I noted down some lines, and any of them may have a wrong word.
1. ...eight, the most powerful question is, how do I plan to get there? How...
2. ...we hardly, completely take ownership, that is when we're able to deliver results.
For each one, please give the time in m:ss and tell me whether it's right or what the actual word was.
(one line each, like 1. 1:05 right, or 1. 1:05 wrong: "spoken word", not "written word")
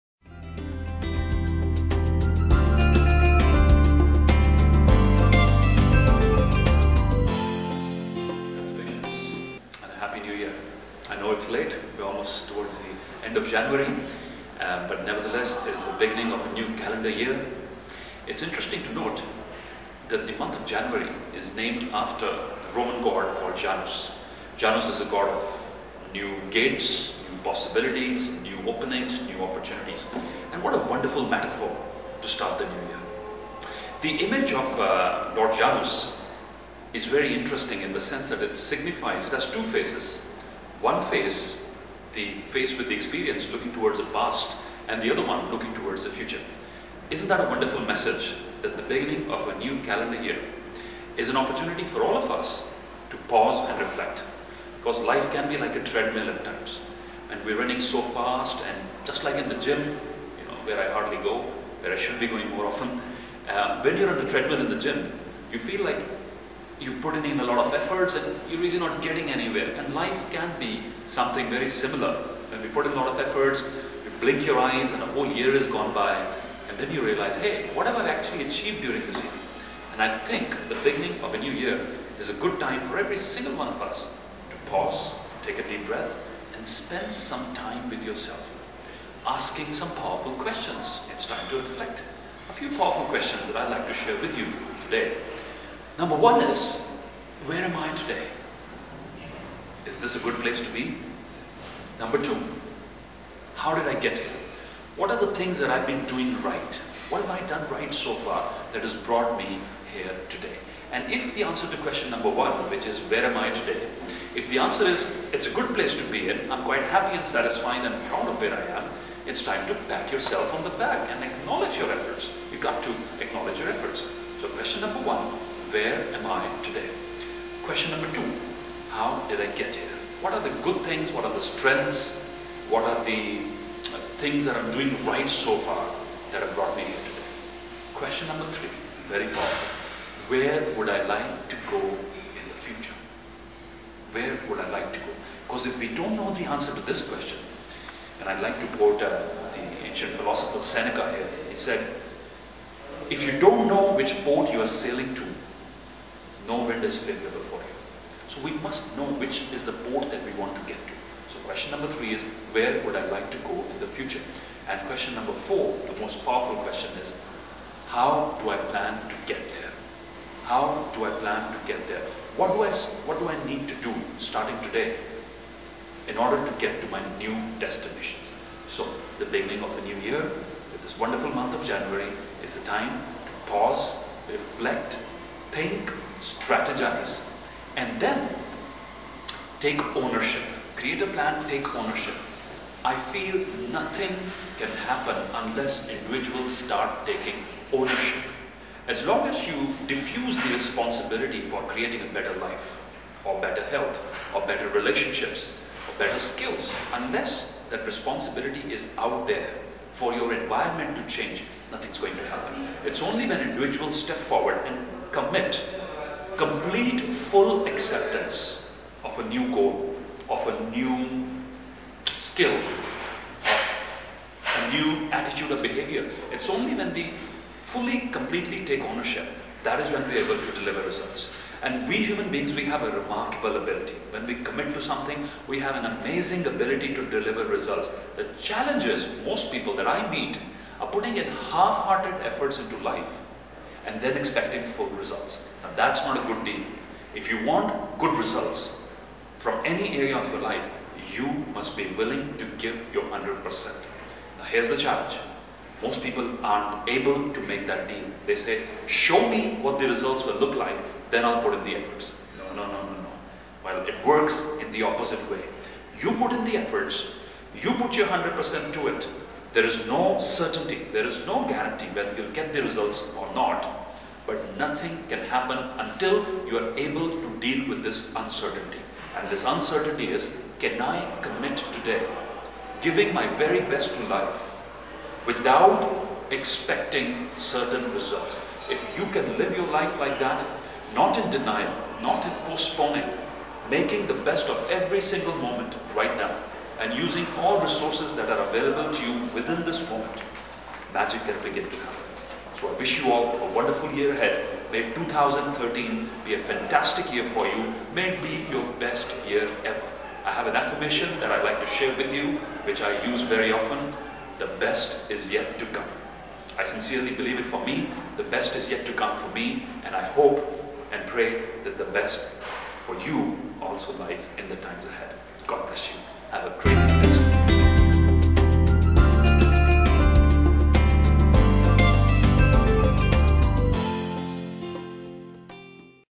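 1. 2:45 wrong: "four", not "eight"
2. 3:46 wrong: "fully", not "hardly".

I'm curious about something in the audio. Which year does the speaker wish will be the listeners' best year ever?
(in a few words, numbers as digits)
2013.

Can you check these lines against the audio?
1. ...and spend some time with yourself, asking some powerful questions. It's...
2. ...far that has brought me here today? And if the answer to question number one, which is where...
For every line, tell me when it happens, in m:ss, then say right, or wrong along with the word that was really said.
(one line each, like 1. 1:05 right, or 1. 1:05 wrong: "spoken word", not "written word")
1. 1:26 right
2. 1:48 right.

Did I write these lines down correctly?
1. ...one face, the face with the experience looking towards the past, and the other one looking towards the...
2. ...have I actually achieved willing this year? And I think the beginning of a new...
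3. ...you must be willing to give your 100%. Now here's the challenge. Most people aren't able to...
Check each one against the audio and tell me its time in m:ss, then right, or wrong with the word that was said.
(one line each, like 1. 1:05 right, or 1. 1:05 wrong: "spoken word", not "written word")
1. 0:40 right
2. 1:17 wrong: "during", not "willing"
3. 4:11 right.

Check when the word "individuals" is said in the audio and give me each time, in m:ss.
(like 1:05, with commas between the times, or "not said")
3:15, 3:33.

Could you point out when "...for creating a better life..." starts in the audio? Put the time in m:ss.
3:21.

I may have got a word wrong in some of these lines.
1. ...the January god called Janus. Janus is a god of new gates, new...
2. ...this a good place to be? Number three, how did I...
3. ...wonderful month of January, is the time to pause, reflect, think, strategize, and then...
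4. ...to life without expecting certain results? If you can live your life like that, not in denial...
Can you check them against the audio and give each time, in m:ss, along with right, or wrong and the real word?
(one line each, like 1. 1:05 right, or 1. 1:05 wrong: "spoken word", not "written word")
1. 0:22 wrong: "Roman", not "January"
2. 1:39 wrong: "two", not "three"
3. 3:00 right
4. 4:43 right.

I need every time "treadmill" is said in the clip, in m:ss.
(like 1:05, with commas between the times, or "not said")
0:55, 1:04.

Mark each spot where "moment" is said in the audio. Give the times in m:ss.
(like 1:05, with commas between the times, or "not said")
4:55, 4:59.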